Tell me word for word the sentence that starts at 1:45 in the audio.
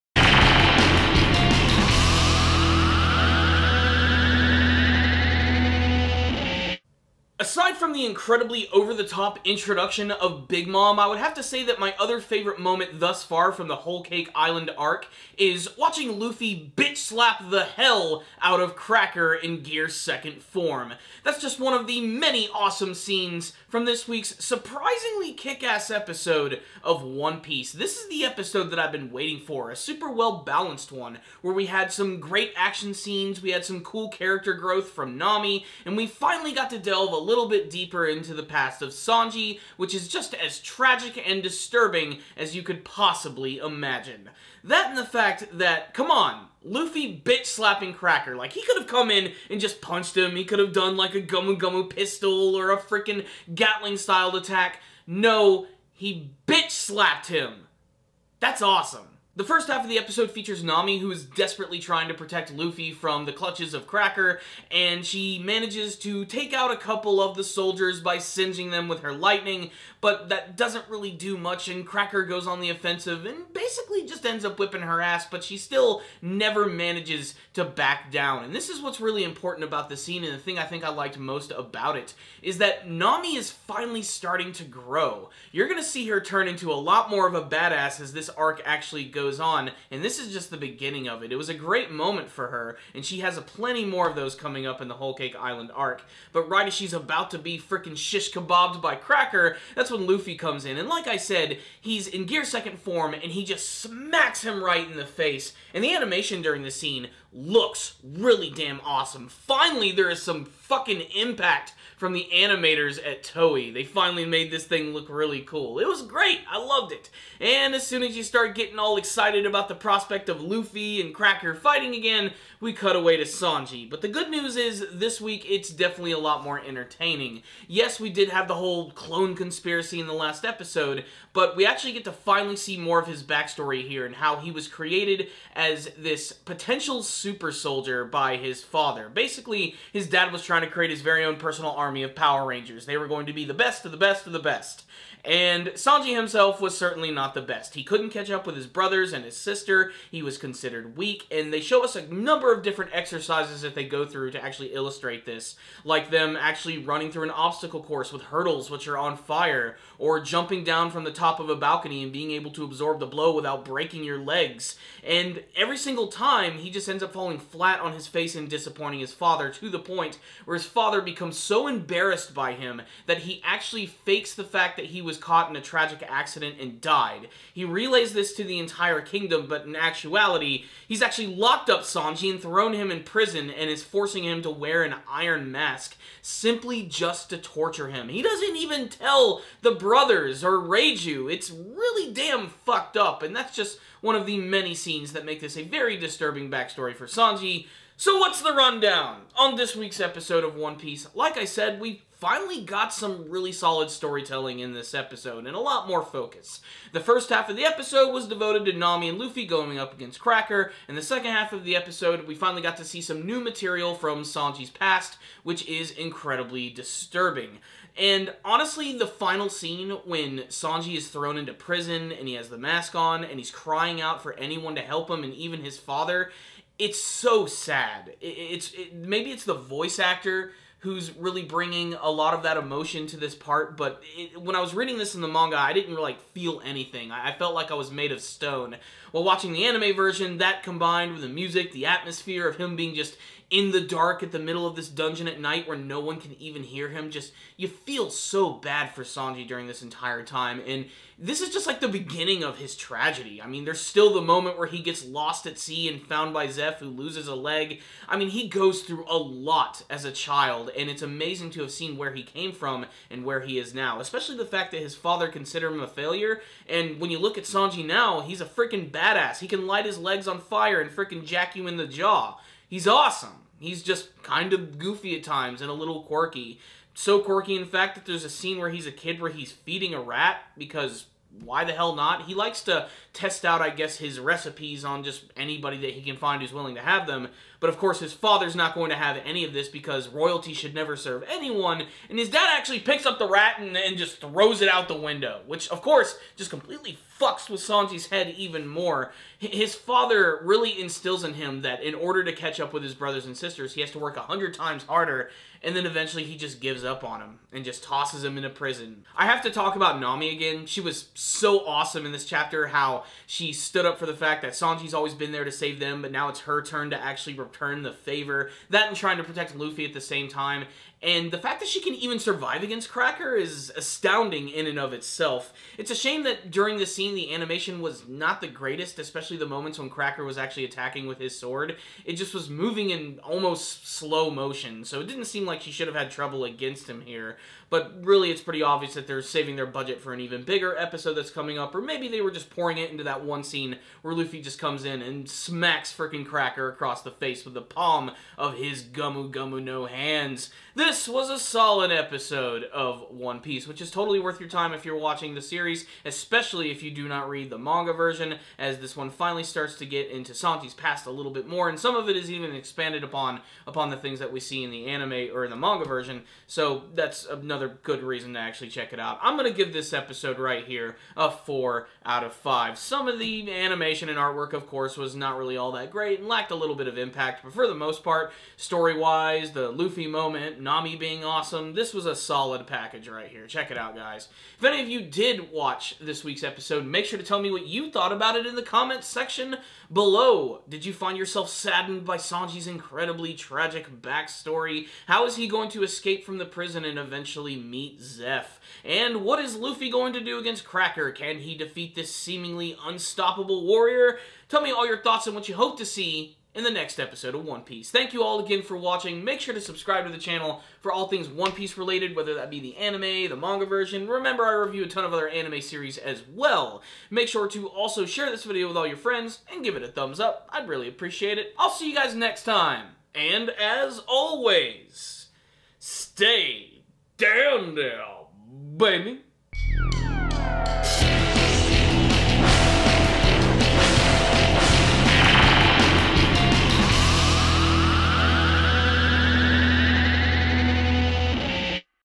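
And the animation during the scene looks really damn awesome.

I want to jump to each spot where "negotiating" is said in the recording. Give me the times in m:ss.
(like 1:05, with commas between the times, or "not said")
not said.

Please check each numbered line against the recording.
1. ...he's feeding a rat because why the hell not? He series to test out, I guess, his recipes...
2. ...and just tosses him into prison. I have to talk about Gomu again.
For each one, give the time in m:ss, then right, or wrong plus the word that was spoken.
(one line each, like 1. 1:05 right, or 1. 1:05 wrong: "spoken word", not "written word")
1. 4:39 wrong: "likes", not "series"
2. 5:07 wrong: "Nami", not "Gomu".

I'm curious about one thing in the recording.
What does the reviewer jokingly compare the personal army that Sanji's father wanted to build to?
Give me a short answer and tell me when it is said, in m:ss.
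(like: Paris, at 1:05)
Power Rangers, at 2:22.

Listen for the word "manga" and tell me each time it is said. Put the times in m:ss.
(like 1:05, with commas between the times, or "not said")
3:55, 5:57, 6:05, 6:53.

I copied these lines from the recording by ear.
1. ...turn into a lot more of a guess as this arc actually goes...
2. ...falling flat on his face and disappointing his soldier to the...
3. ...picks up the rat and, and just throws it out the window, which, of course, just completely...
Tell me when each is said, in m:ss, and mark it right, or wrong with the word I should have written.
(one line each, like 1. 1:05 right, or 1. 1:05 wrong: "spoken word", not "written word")
1. 1:26 wrong: "badass", not "guess"
2. 2:47 wrong: "father", not "soldier"
3. 4:52 right.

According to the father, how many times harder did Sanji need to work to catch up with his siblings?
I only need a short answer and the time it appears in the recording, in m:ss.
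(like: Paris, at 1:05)
100, at 5:04.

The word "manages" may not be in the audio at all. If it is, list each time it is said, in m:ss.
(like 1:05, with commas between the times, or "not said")
1:05, 1:16.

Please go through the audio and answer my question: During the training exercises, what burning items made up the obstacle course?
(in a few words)
hurdles.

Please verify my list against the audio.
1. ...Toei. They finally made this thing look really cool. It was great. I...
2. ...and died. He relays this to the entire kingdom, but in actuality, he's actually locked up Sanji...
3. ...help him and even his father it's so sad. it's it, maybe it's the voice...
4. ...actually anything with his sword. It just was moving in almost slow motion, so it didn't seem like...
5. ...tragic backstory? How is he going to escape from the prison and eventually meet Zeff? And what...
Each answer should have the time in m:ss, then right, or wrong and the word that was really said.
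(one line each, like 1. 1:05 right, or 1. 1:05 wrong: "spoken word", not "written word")
1. 1:53 right
2. 2:56 right
3. 3:44 right
4. 5:30 wrong: "attacking", not "anything"
5. 6:33 right.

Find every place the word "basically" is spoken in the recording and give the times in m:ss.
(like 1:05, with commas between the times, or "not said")
1:13, 2:19.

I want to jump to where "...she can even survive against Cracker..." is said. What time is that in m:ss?
5:21.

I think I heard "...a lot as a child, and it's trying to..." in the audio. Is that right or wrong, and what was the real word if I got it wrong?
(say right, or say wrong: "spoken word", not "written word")
wrong: "amazing", not "trying".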